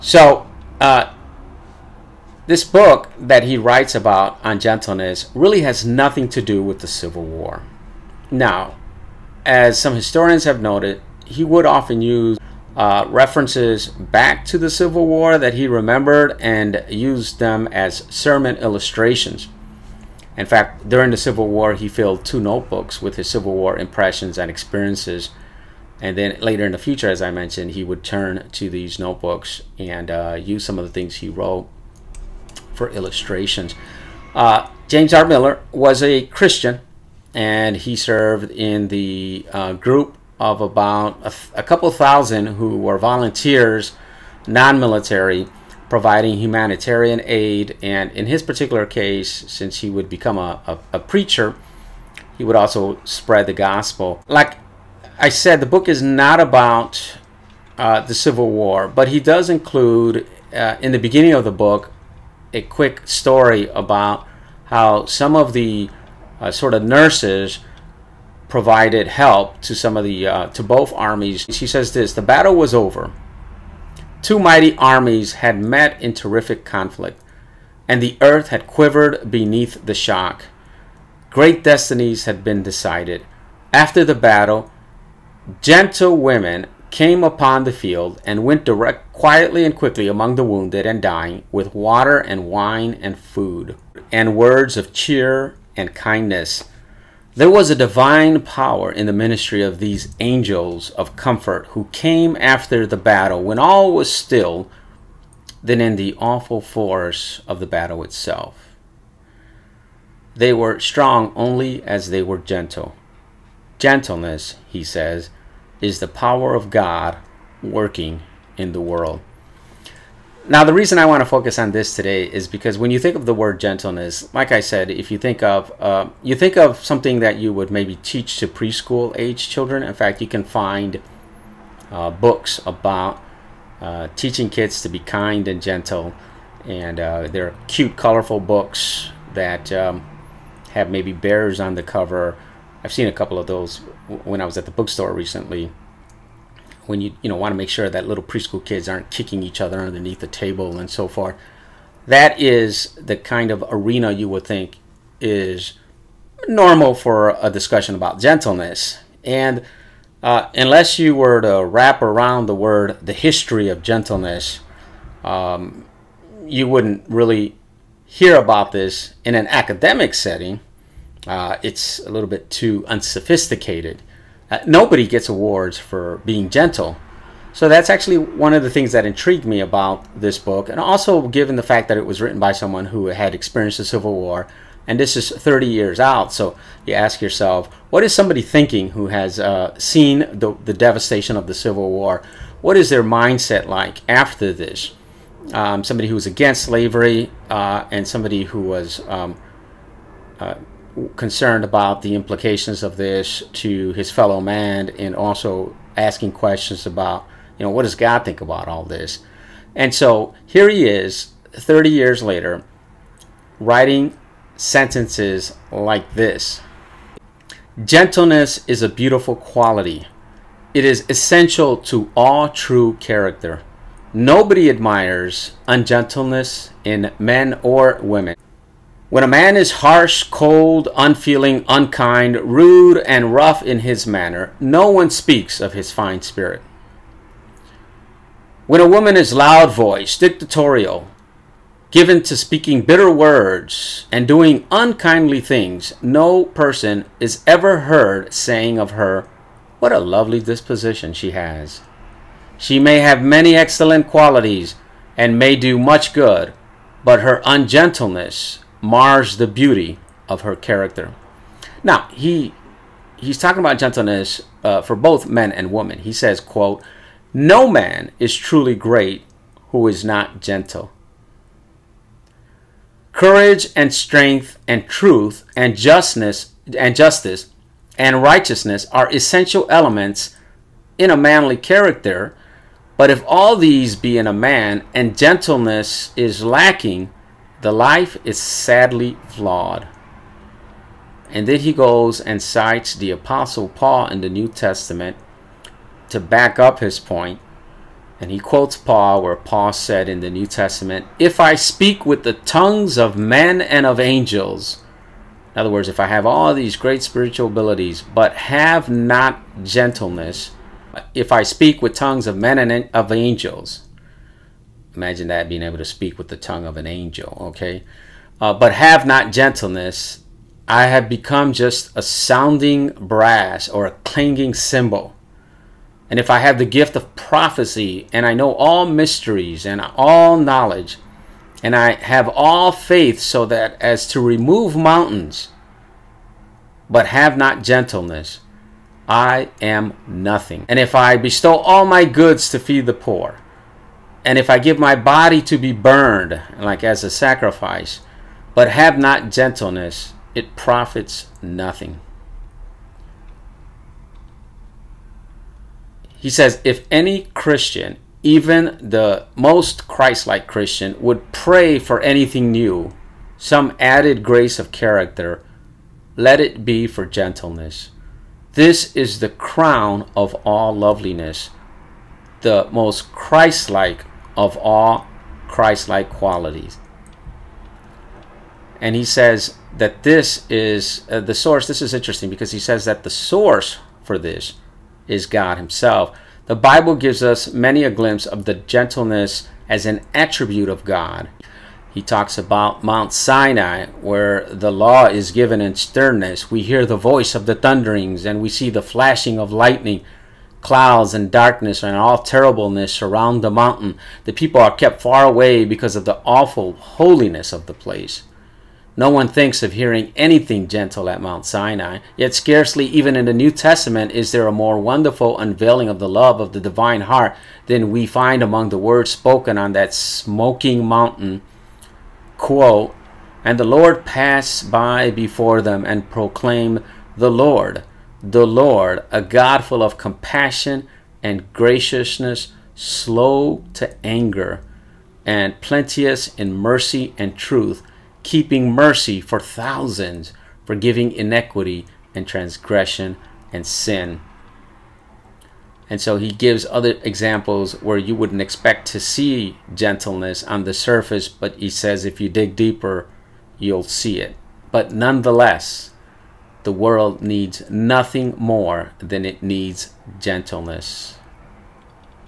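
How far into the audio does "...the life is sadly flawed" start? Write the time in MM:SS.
04:47.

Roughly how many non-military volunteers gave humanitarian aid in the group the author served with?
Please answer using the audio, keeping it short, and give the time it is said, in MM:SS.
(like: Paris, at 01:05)
a couple thousand, at 00:41.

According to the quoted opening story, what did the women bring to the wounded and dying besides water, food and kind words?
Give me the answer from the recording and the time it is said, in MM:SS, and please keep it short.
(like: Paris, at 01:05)
wine, at 01:32.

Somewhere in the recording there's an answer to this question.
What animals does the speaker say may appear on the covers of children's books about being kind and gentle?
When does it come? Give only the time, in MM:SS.
02:21.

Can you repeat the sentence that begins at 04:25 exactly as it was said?
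He says, quote, no man is truly great who is not gentle.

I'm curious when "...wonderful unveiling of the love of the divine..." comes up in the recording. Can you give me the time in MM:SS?
06:54.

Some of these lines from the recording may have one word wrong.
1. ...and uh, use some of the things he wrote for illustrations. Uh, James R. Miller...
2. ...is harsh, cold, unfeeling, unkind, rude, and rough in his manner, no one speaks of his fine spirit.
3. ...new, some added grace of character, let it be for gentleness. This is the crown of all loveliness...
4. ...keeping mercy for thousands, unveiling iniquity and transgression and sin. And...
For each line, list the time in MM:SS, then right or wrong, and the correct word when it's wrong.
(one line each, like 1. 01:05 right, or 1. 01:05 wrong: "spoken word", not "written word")
1. 00:29 right
2. 03:49 right
3. 06:02 right
4. 07:18 wrong: "forgiving", not "unveiling".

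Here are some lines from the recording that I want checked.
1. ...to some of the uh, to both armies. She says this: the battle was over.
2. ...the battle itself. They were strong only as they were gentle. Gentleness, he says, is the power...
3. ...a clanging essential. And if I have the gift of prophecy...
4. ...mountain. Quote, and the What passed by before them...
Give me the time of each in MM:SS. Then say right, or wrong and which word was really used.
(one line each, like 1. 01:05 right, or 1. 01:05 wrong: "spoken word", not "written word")
1. 01:09 right
2. 01:47 right
3. 05:23 wrong: "cymbal", not "essential"
4. 07:00 wrong: "Lord", not "What".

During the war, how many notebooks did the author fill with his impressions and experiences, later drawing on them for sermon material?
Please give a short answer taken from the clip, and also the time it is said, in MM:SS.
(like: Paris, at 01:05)
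2, at 00:22.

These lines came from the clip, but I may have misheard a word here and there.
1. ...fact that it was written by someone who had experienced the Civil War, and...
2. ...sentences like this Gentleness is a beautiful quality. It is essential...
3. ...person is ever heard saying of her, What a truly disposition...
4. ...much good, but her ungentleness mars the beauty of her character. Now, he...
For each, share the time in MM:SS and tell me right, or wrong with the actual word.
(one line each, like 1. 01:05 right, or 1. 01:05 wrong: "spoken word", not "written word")
1. 03:01 right
2. 03:34 right
3. 04:06 wrong: "lovely", not "truly"
4. 04:15 right.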